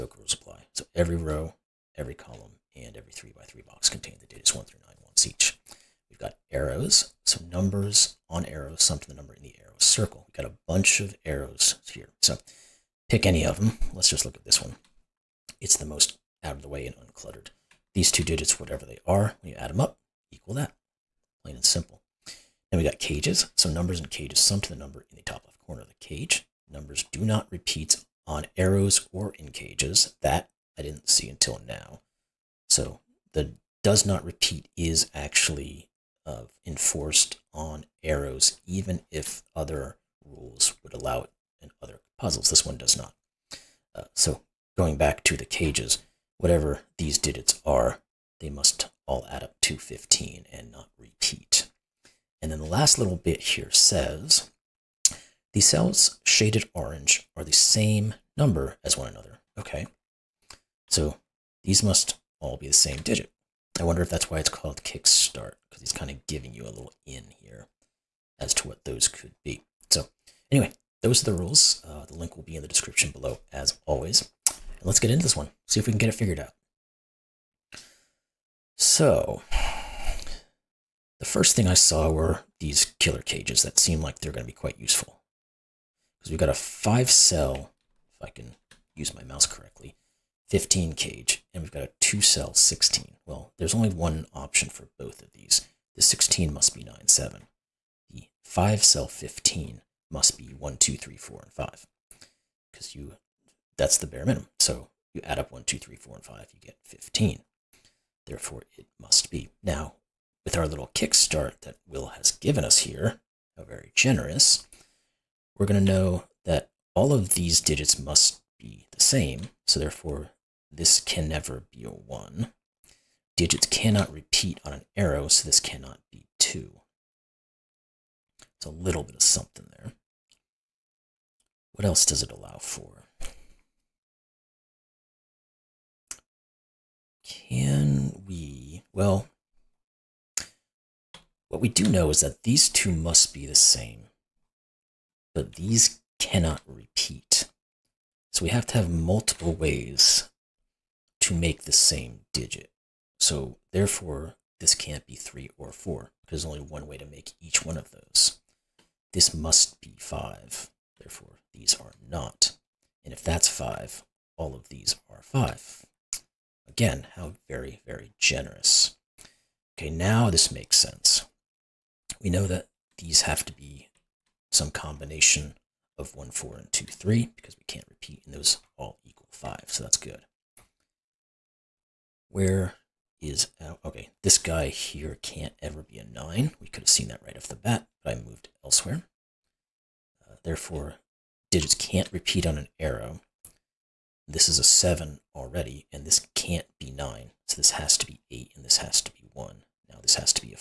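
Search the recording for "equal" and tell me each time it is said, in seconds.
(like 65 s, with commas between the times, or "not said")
20 s, 179 s.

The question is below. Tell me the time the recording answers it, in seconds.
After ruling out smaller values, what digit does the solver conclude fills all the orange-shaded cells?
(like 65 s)
159 s.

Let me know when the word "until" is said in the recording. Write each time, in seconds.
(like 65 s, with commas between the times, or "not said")
31 s.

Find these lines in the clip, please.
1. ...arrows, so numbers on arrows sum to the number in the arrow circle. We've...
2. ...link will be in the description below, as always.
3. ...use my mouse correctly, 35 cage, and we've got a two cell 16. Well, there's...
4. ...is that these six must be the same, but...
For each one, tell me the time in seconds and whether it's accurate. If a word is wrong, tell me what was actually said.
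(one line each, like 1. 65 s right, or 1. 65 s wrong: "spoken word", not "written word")
1. 6 s right
2. 72 s right
3. 88 s wrong: "15", not "35"
4. 142 s wrong: "two", not "six".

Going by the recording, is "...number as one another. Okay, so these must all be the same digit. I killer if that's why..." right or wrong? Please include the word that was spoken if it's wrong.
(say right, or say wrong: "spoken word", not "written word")
wrong: "wonder", not "killer".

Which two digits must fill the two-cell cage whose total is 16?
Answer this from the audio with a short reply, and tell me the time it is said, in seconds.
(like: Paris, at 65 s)
9, 7, at 96 s.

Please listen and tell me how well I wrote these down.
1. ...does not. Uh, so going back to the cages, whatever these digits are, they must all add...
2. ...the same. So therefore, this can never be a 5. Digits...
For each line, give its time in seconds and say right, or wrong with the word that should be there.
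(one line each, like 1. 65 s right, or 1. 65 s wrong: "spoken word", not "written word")
1. 42 s right
2. 118 s wrong: "1", not "5".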